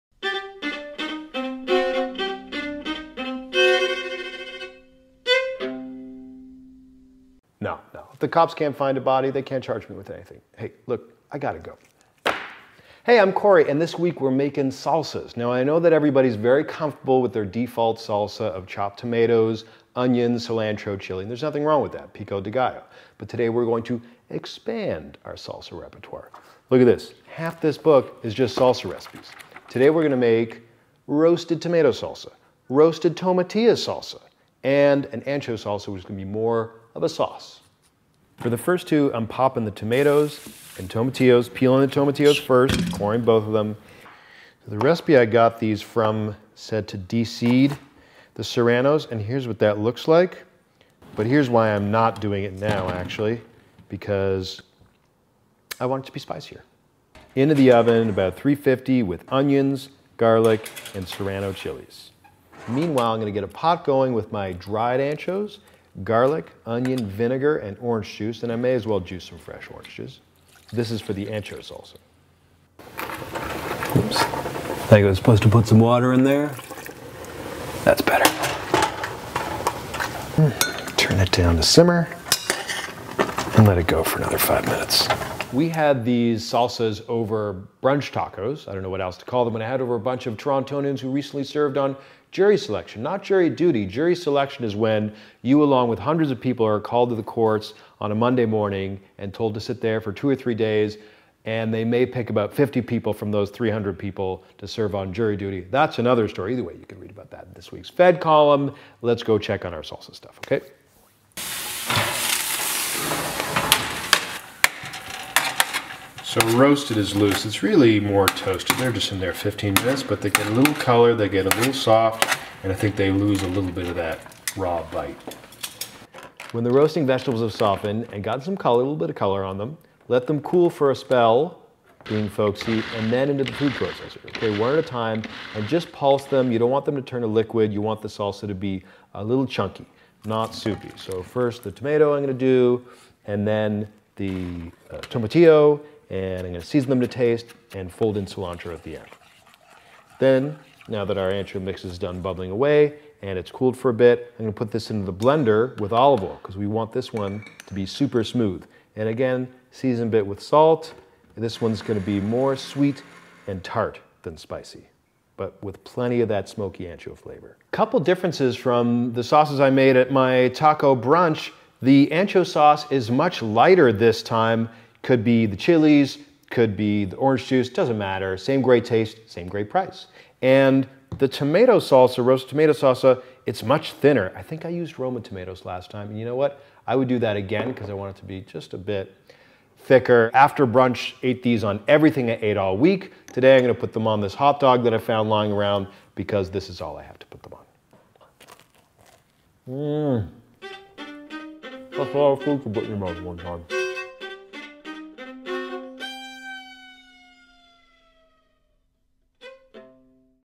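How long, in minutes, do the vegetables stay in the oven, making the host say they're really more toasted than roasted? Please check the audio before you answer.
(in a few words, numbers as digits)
15.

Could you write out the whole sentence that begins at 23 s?
But today we're going to expand our salsa repertoire.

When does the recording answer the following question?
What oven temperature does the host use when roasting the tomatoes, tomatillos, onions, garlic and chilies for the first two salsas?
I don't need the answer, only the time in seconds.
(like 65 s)
58 s.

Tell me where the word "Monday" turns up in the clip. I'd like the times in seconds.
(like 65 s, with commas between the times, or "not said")
98 s.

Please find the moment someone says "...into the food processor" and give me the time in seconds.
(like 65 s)
133 s.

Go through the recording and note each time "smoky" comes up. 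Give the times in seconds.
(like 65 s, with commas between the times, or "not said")
166 s.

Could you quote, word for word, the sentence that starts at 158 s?
And again, season a bit with salt.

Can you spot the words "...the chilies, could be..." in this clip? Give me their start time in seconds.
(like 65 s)
175 s.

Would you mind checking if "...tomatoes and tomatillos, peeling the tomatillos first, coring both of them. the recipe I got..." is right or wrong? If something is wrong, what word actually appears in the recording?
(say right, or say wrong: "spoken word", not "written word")
right.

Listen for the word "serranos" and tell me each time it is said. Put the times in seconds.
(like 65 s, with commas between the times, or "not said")
48 s, 61 s.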